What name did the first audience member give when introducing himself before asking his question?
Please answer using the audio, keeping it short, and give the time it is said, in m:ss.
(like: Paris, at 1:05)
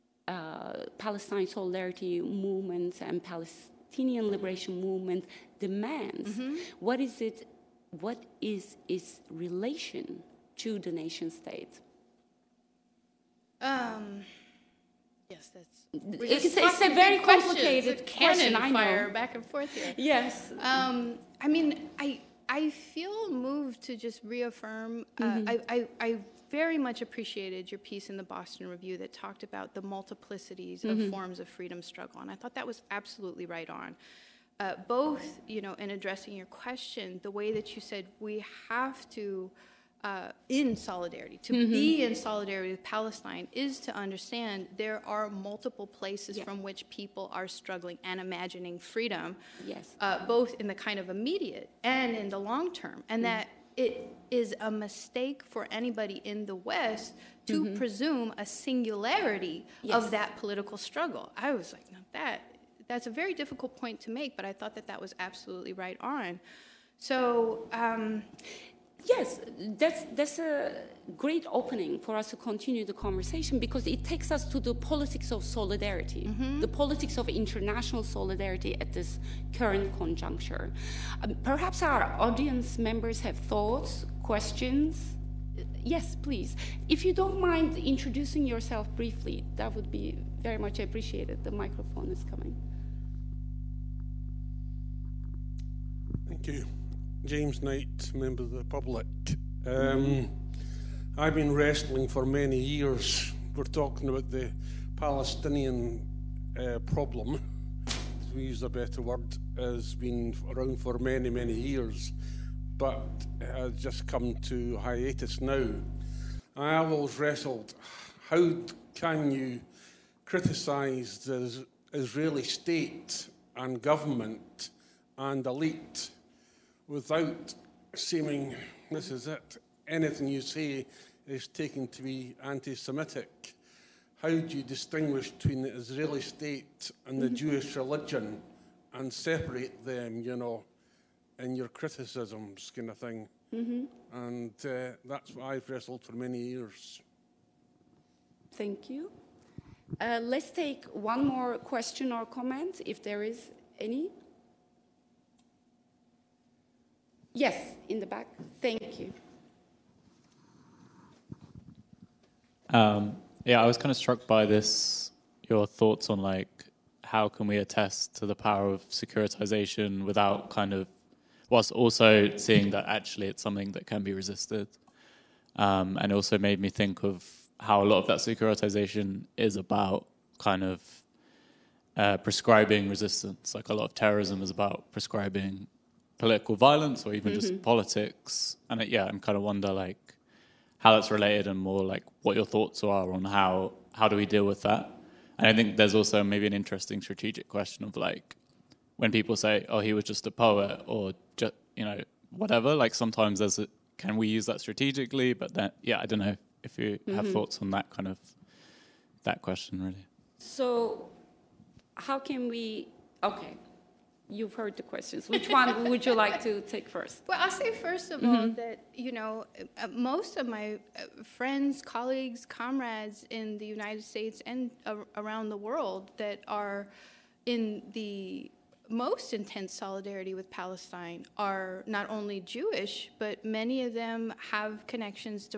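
James Knight, at 1:37.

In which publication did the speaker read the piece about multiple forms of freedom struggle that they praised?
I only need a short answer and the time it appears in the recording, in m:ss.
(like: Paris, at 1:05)
Boston Review, at 0:28.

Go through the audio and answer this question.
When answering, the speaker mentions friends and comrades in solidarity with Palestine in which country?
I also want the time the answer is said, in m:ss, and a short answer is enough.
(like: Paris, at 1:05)
United States, at 3:43.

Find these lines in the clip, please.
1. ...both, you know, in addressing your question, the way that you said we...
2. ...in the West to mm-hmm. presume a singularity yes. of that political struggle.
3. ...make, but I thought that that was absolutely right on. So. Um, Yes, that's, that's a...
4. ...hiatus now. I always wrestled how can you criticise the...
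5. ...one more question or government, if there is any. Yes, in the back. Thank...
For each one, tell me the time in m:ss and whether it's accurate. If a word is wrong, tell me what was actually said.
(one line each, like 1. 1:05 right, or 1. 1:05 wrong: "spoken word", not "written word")
1. 0:34 right
2. 0:56 right
3. 1:04 right
4. 1:54 right
5. 2:30 wrong: "comment", not "government".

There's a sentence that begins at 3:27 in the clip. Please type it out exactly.
have thoughts on that kind of that question really.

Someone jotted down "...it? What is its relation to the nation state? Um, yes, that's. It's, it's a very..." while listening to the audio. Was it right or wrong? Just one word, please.
right.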